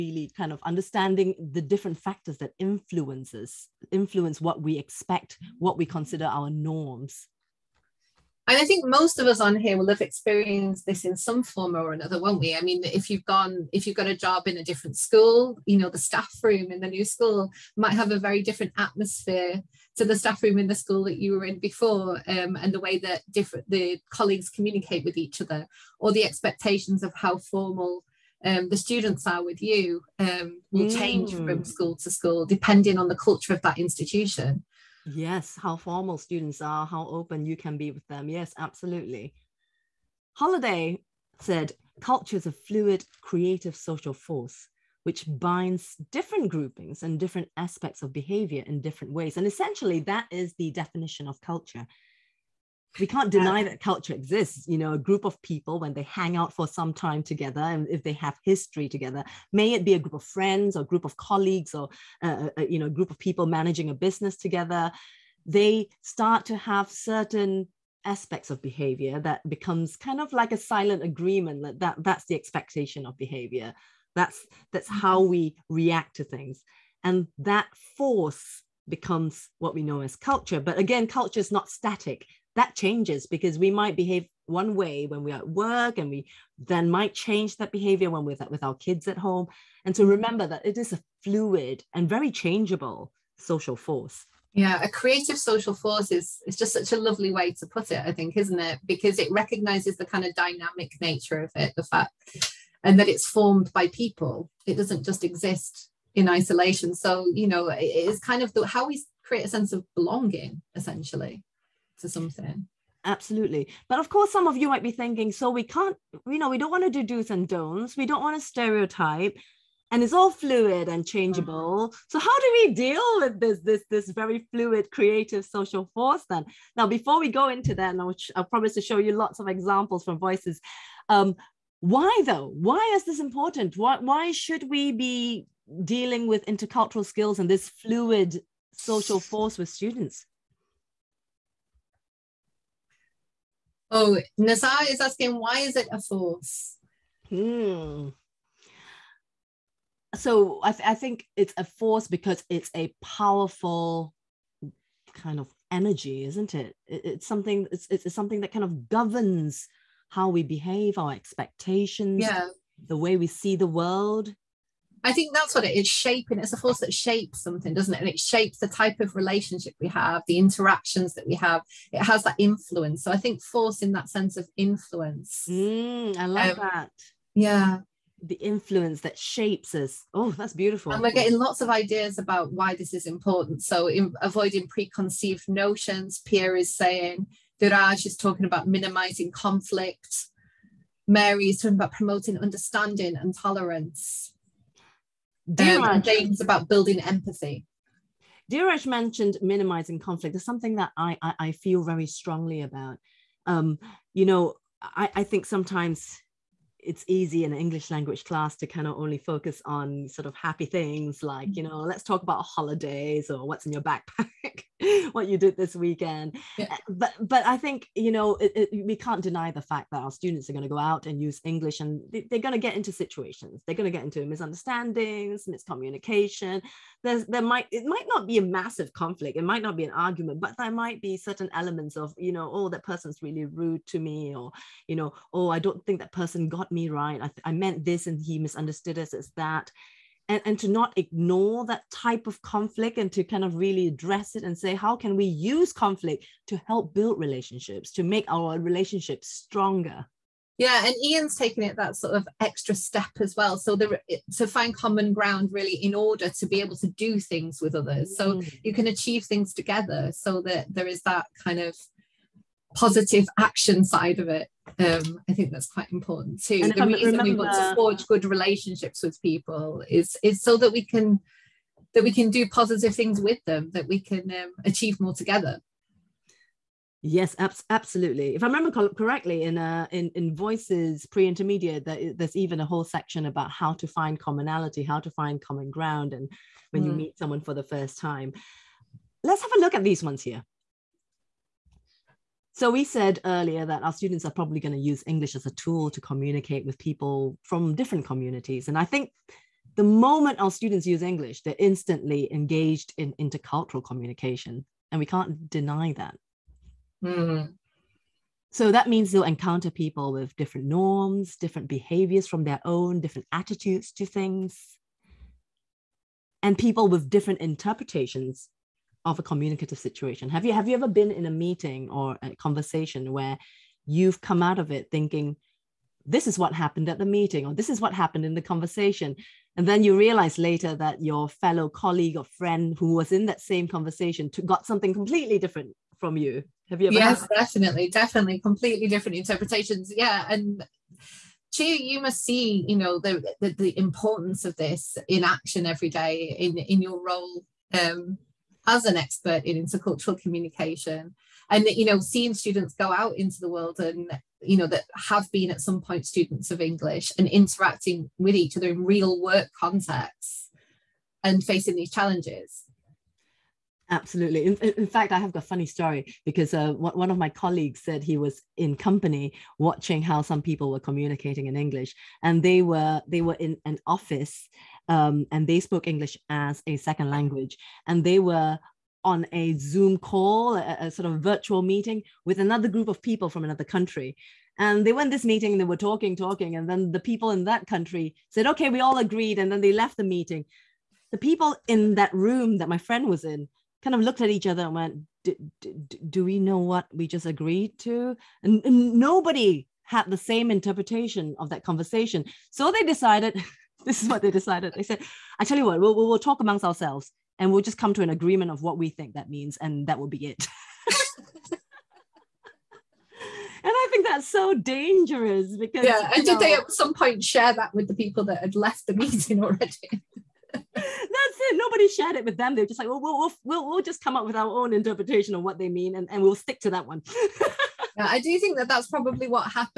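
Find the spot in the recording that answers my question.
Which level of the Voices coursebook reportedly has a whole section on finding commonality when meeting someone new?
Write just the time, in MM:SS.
04:41.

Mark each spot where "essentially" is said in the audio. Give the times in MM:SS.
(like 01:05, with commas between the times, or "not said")
00:49, 01:50.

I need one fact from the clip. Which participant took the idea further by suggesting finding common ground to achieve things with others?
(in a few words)
Ian.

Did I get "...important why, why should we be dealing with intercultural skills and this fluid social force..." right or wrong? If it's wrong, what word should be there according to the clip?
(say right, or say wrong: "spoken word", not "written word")
right.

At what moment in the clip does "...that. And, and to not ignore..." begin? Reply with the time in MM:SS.
03:59.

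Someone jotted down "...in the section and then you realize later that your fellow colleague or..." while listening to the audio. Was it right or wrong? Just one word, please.
wrong.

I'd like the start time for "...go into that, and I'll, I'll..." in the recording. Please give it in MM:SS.
02:07.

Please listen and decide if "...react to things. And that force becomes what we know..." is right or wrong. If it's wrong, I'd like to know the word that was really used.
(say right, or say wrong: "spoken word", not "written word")
right.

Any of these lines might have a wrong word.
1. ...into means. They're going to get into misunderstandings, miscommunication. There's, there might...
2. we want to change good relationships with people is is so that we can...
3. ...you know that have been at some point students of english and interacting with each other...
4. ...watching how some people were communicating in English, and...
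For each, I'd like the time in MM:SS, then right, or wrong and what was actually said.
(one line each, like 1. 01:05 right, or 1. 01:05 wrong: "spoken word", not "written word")
1. 03:42 wrong: "situations", not "means"
2. 04:27 wrong: "forge", not "change"
3. 05:54 right
4. 06:09 right.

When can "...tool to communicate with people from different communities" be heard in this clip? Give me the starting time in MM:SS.
04:55.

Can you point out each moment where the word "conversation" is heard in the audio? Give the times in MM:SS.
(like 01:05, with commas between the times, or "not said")
05:22, 05:28, 05:33, 06:41.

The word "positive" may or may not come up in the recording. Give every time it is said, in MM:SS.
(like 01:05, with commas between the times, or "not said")
04:22, 04:32.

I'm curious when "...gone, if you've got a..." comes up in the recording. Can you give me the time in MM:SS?
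00:13.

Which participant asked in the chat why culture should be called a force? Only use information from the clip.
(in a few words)
Nasa.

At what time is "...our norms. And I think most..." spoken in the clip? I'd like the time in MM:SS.
00:06.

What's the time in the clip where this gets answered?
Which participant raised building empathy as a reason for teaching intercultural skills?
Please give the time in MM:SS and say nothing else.
03:16.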